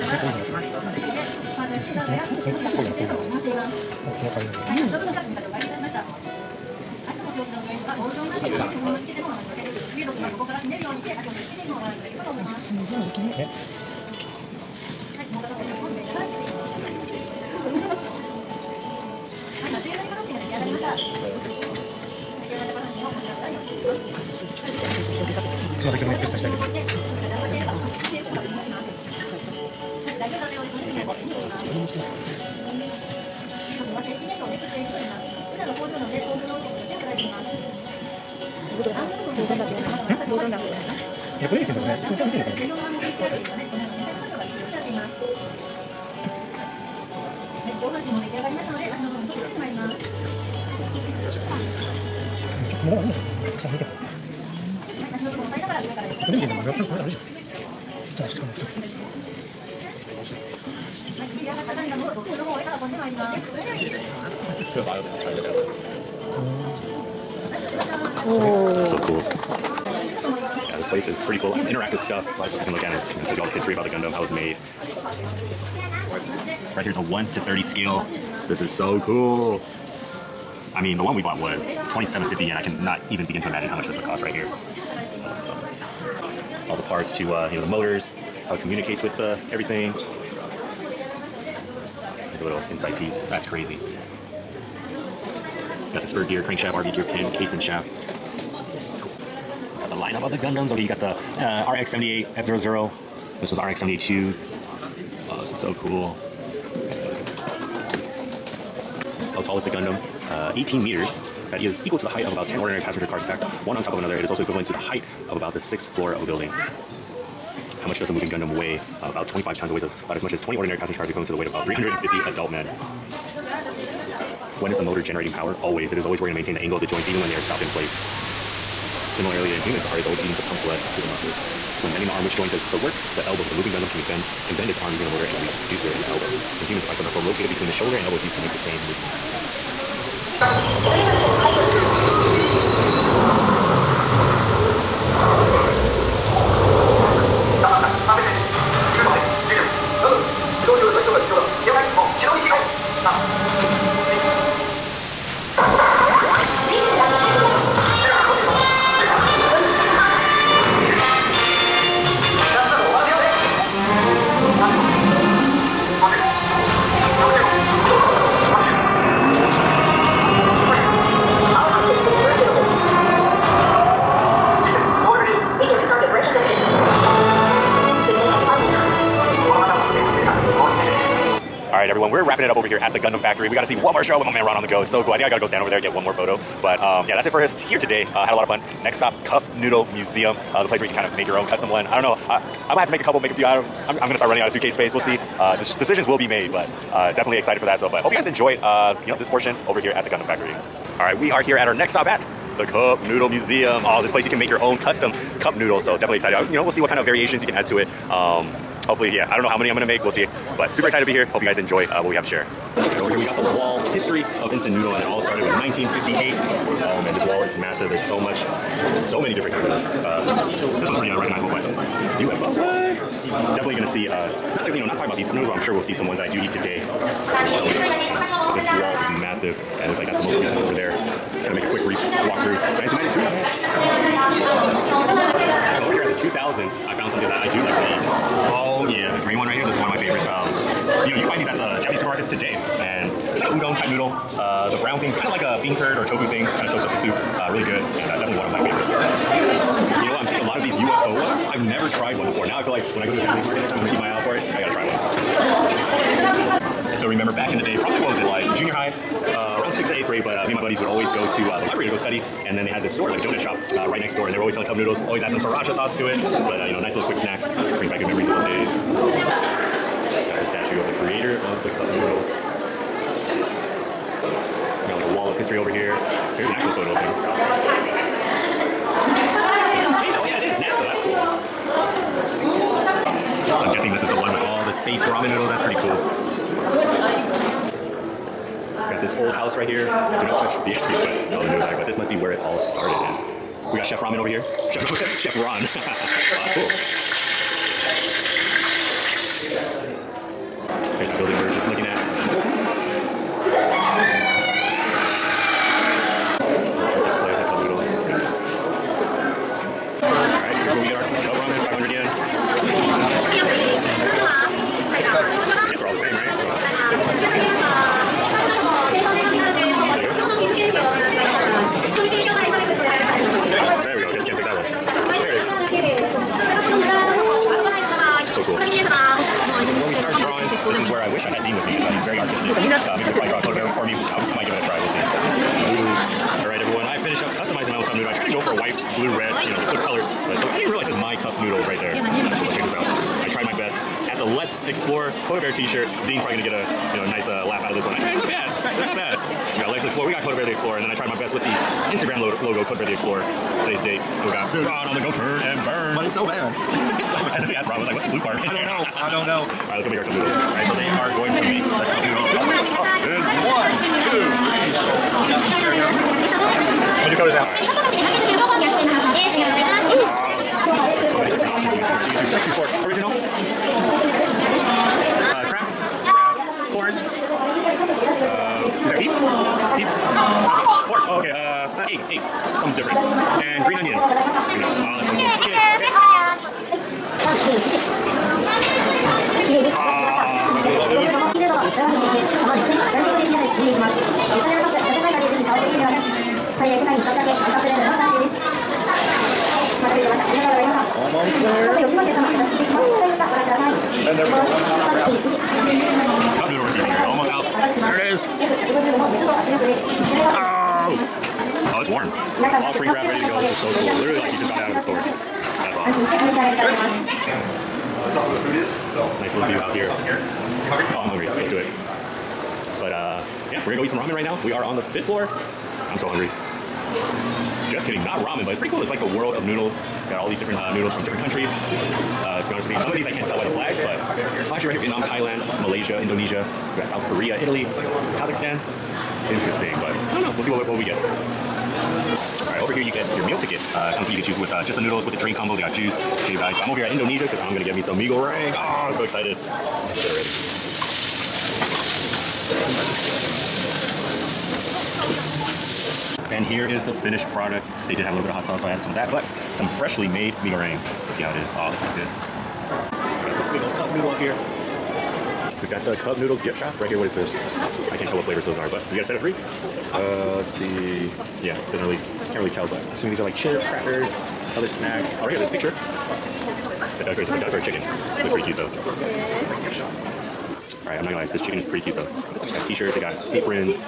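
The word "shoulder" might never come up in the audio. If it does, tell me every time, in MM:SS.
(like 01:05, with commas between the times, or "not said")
02:17, 06:07.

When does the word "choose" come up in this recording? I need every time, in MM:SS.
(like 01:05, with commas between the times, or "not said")
06:12, 07:24.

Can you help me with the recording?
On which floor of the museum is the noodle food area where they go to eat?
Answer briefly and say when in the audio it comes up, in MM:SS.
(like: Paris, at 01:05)
fifth floor, at 07:04.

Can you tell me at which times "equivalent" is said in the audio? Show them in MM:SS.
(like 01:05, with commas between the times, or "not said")
01:54, 02:01.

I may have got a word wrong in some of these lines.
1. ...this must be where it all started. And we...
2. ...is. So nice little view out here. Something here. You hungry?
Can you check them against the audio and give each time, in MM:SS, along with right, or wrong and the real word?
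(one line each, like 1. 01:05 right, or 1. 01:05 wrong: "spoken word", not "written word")
1. 04:51 right
2. 06:58 right.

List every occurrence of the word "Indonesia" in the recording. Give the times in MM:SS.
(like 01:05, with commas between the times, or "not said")
07:16, 07:26.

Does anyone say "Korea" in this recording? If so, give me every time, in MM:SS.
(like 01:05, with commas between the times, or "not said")
07:17.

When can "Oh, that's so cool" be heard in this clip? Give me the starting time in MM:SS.
06:24.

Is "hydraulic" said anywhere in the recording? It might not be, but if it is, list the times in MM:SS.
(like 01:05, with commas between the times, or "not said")
not said.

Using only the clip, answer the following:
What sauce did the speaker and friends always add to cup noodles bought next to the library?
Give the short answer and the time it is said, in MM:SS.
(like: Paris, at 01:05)
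sriracha, at 04:25.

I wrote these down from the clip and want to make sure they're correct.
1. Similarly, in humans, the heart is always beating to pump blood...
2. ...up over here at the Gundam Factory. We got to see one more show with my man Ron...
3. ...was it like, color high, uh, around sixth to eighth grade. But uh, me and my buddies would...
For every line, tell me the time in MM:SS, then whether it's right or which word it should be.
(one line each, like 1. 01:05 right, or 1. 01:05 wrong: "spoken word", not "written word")
1. 02:09 right
2. 03:02 right
3. 04:18 wrong: "junior", not "color".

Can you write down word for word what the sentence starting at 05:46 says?
Dean's probably gonna get a you know, nice uh, laugh out of this one.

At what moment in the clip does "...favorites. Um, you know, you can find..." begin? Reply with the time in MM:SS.
03:59.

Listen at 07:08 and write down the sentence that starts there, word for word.
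It's like the world of noodles.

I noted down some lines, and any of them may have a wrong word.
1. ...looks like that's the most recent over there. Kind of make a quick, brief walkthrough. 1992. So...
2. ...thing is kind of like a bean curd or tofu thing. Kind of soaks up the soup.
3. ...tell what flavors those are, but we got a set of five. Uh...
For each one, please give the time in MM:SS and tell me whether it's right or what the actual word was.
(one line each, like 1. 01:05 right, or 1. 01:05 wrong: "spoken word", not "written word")
1. 03:49 right
2. 04:05 right
3. 07:48 wrong: "three", not "five".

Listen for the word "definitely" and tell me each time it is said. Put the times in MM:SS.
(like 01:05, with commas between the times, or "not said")
03:17, 03:25, 03:43.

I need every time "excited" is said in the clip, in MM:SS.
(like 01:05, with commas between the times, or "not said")
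03:17, 03:26, 03:30, 07:29.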